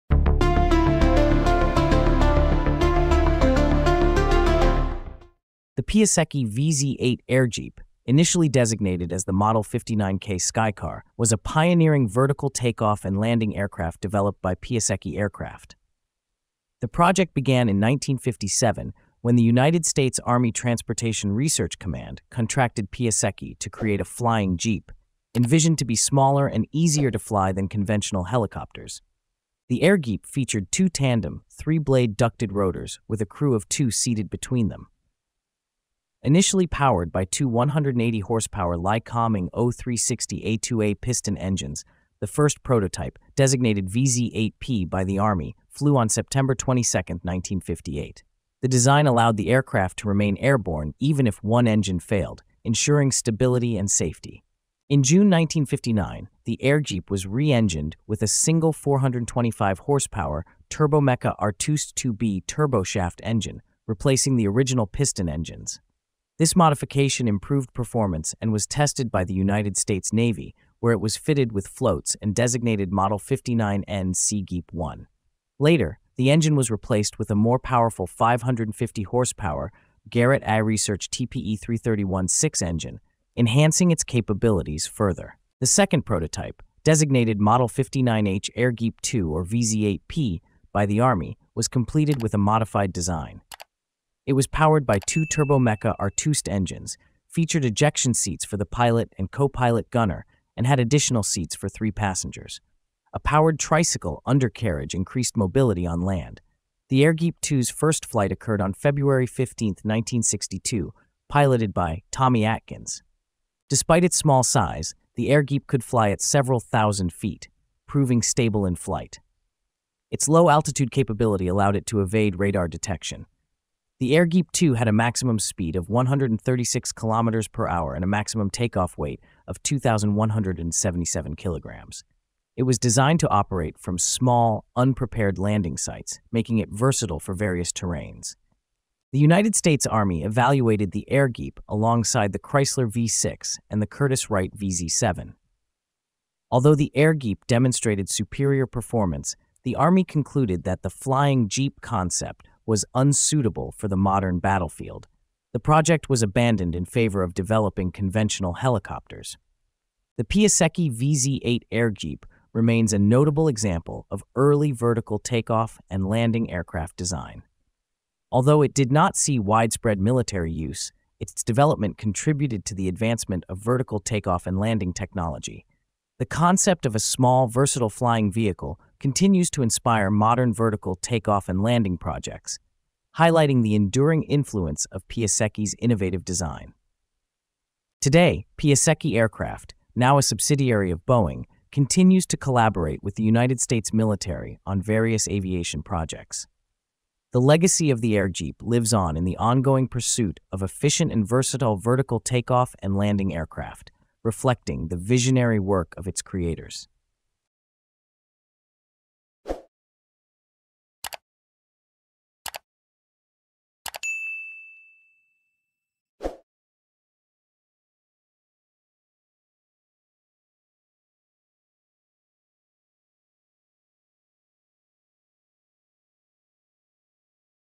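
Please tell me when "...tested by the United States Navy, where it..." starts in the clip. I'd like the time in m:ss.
1:08.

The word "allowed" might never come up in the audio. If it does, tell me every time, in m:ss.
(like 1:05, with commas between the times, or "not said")
0:49, 2:01.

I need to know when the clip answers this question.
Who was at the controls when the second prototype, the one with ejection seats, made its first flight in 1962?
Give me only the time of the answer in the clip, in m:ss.
1:52.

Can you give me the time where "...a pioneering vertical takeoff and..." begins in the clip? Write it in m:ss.
0:11.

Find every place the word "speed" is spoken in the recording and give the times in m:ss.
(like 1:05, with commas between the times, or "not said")
2:05.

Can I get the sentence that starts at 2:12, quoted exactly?
It was designed to operate from small, unprepared landing sites, making it versatile for various terrains.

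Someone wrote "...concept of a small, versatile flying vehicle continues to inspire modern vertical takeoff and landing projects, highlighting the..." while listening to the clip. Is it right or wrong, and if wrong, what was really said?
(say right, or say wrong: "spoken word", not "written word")
right.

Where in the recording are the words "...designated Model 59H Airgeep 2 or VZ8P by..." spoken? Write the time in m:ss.
1:26.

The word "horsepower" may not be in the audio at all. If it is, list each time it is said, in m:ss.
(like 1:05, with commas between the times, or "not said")
0:38, 0:59, 1:19.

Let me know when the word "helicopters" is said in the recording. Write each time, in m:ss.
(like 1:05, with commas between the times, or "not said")
0:28, 2:38.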